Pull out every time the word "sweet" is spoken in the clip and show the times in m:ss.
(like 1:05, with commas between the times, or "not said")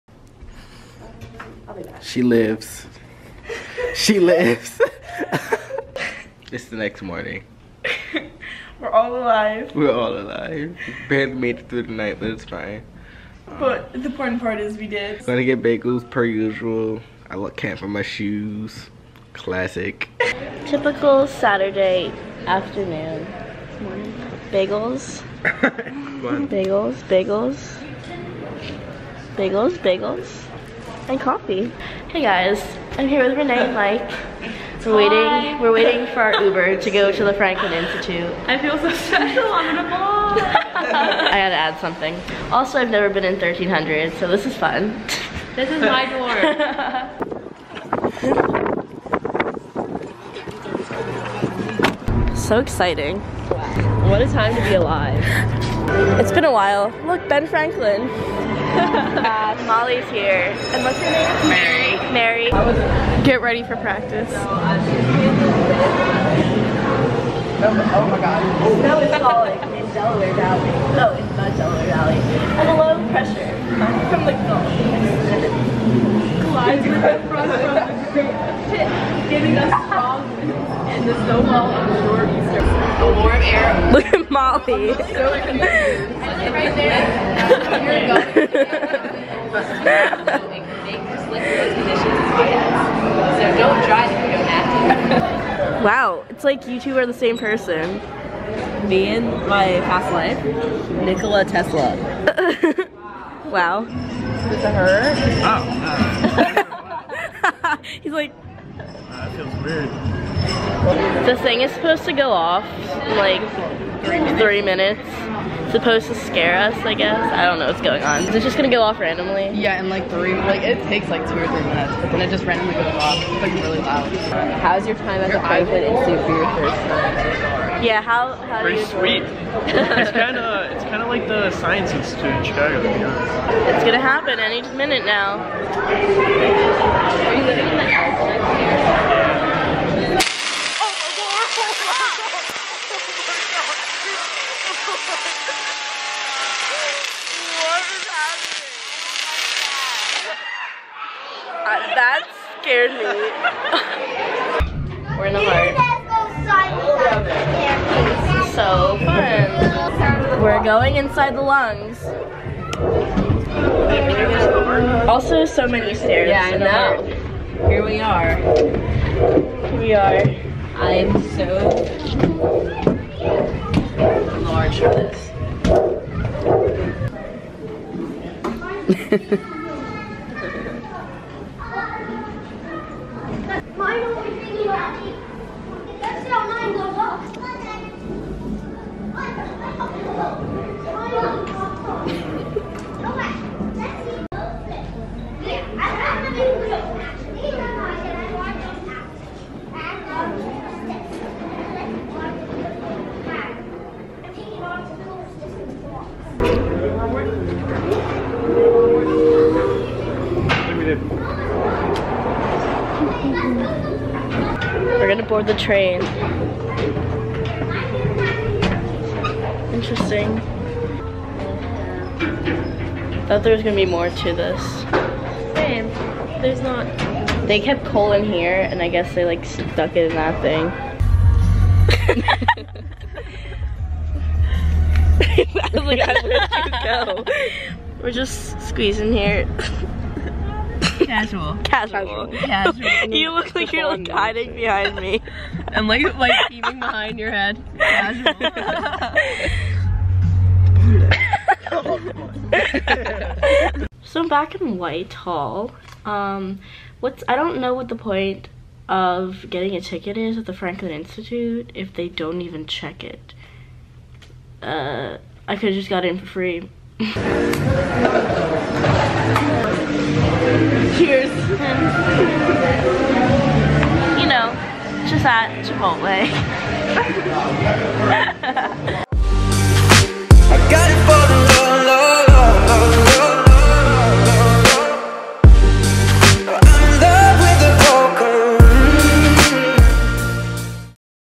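2:08.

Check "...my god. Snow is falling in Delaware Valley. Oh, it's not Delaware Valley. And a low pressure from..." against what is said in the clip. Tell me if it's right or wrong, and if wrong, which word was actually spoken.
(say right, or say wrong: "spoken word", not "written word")
right.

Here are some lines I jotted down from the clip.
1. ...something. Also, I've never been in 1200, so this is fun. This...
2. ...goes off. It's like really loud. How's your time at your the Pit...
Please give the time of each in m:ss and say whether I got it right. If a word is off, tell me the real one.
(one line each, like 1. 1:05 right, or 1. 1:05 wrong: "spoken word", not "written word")
1. 0:41 wrong: "1300", not "1200"
2. 2:02 wrong: "Franklin", not "Pit".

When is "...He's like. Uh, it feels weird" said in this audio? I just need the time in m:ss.
1:48.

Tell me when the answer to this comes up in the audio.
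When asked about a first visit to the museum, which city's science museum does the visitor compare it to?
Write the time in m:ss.
2:12.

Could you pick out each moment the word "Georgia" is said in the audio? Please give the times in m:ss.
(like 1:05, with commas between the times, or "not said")
not said.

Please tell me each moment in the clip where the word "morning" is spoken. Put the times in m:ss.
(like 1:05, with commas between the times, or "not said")
0:07.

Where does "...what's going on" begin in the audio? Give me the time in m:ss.
1:57.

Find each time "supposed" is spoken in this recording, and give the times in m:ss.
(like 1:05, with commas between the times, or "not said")
1:51, 1:55.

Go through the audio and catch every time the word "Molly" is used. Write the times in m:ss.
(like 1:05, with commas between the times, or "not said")
0:59, 1:24.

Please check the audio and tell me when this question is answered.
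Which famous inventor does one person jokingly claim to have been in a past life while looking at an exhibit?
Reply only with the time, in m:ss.
1:41.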